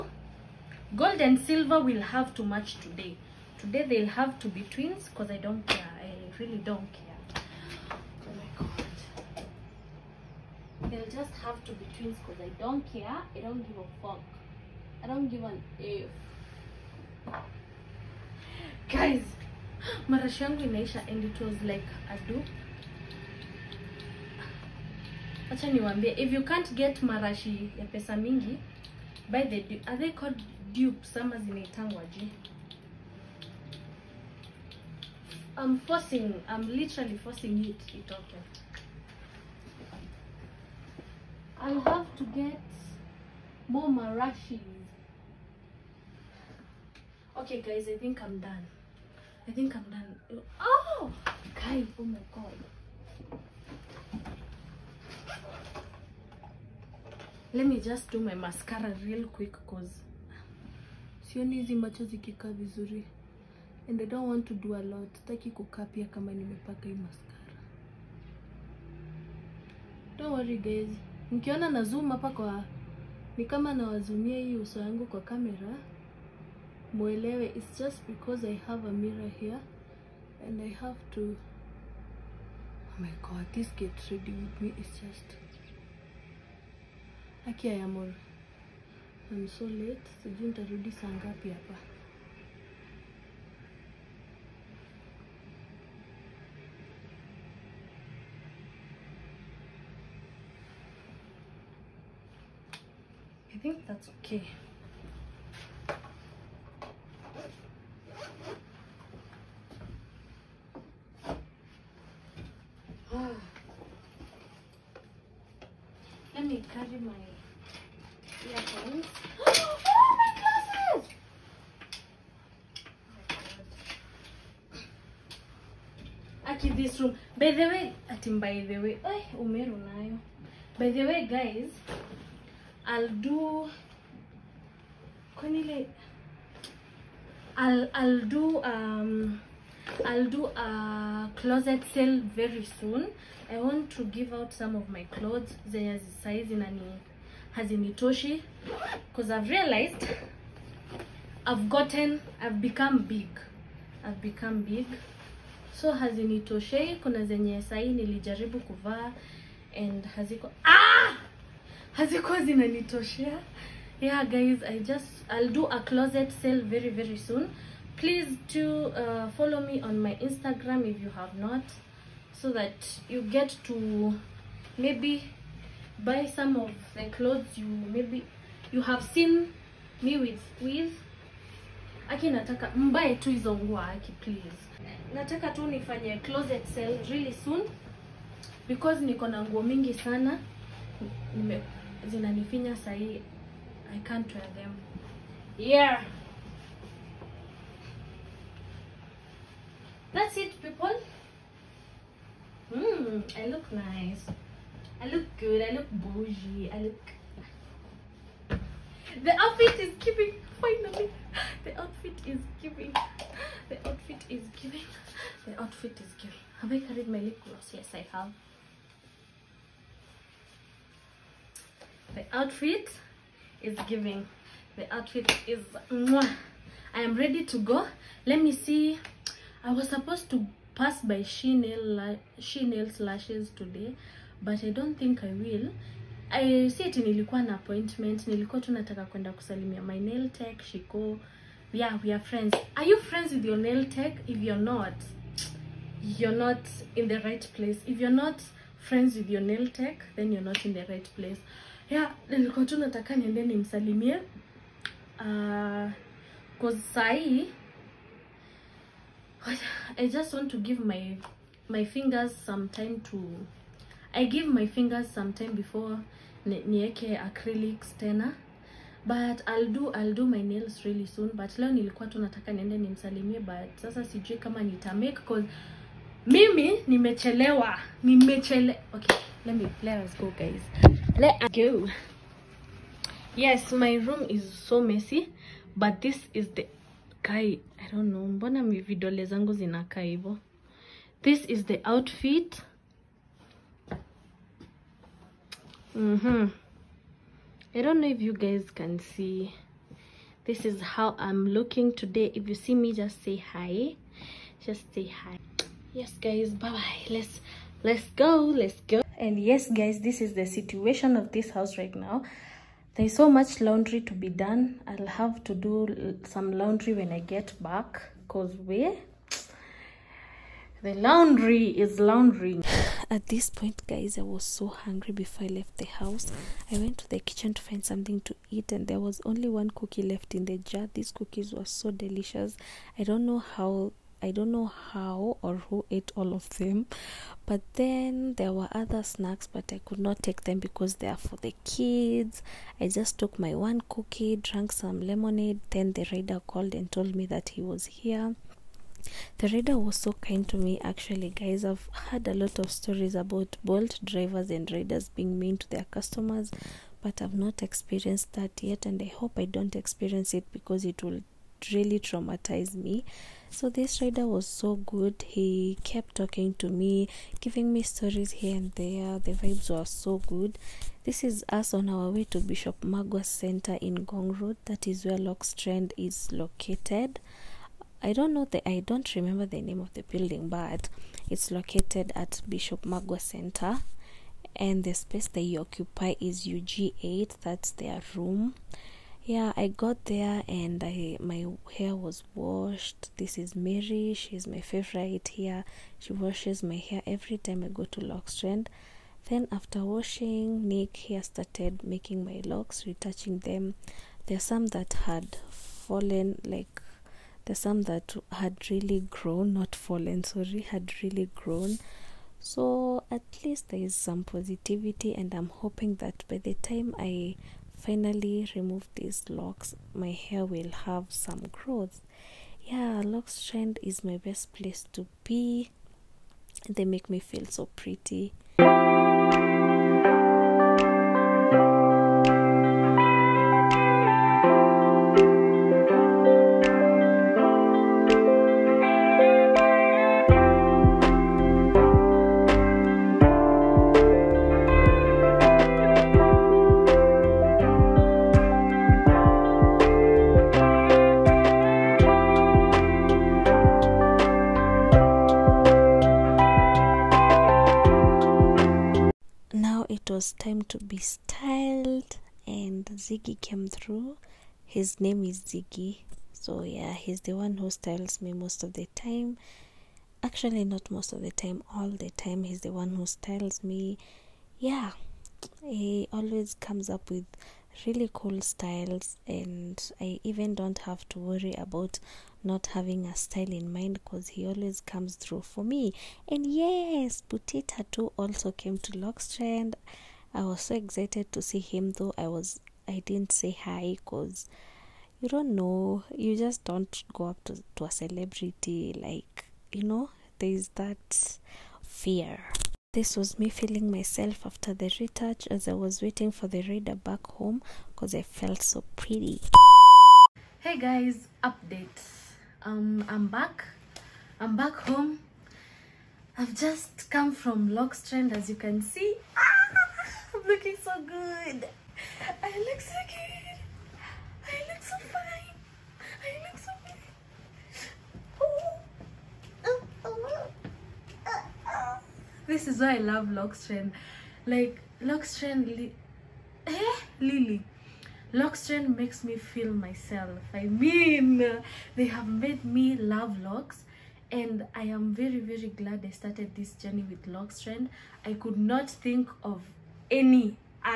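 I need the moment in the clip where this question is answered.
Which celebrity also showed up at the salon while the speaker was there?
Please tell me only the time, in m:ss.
8:07.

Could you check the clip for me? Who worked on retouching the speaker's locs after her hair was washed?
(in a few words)
Nick.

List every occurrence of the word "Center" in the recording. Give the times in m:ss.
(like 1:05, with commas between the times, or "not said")
6:13, 6:23.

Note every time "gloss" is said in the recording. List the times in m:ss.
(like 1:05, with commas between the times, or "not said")
3:37.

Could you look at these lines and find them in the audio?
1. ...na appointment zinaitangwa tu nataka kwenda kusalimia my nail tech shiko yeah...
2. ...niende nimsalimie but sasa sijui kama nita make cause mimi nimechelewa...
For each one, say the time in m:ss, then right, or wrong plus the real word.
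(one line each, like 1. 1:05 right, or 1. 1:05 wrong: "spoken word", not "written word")
1. 3:57 wrong: "nilikuwa", not "zinaitangwa"
2. 4:32 right.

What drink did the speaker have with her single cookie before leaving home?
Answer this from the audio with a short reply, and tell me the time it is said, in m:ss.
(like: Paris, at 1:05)
Lemonade, at 5:44.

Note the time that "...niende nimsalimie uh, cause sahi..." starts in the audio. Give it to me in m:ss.
4:13.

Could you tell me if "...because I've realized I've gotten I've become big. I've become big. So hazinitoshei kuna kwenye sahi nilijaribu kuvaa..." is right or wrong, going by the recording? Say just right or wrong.
wrong.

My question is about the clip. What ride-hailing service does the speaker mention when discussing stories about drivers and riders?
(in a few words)
Bolt.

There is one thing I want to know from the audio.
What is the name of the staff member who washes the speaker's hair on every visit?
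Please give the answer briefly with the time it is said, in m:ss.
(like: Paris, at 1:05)
Mary, at 6:33.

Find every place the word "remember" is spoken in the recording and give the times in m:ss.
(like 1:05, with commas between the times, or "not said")
6:19.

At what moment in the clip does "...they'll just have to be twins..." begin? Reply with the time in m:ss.
0:10.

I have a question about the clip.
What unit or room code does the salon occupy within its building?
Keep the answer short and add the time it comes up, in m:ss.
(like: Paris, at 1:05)
UG8, at 6:26.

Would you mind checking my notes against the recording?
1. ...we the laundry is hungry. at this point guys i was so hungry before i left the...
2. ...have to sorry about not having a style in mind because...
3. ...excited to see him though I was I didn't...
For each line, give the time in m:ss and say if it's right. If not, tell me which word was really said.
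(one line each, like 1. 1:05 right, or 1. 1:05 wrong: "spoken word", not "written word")
1. 5:18 wrong: "laundry", not "hungry"
2. 8:00 wrong: "worry", not "sorry"
3. 8:10 right.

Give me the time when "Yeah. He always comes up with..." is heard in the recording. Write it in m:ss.
7:54.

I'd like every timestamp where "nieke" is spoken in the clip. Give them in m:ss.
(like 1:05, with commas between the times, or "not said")
4:26.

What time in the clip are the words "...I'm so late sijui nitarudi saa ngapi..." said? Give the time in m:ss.
1:27.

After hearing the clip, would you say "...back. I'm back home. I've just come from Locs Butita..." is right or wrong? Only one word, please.
wrong.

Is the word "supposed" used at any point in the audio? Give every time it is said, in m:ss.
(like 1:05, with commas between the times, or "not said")
3:49.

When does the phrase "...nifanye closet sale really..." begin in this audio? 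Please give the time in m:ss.
3:05.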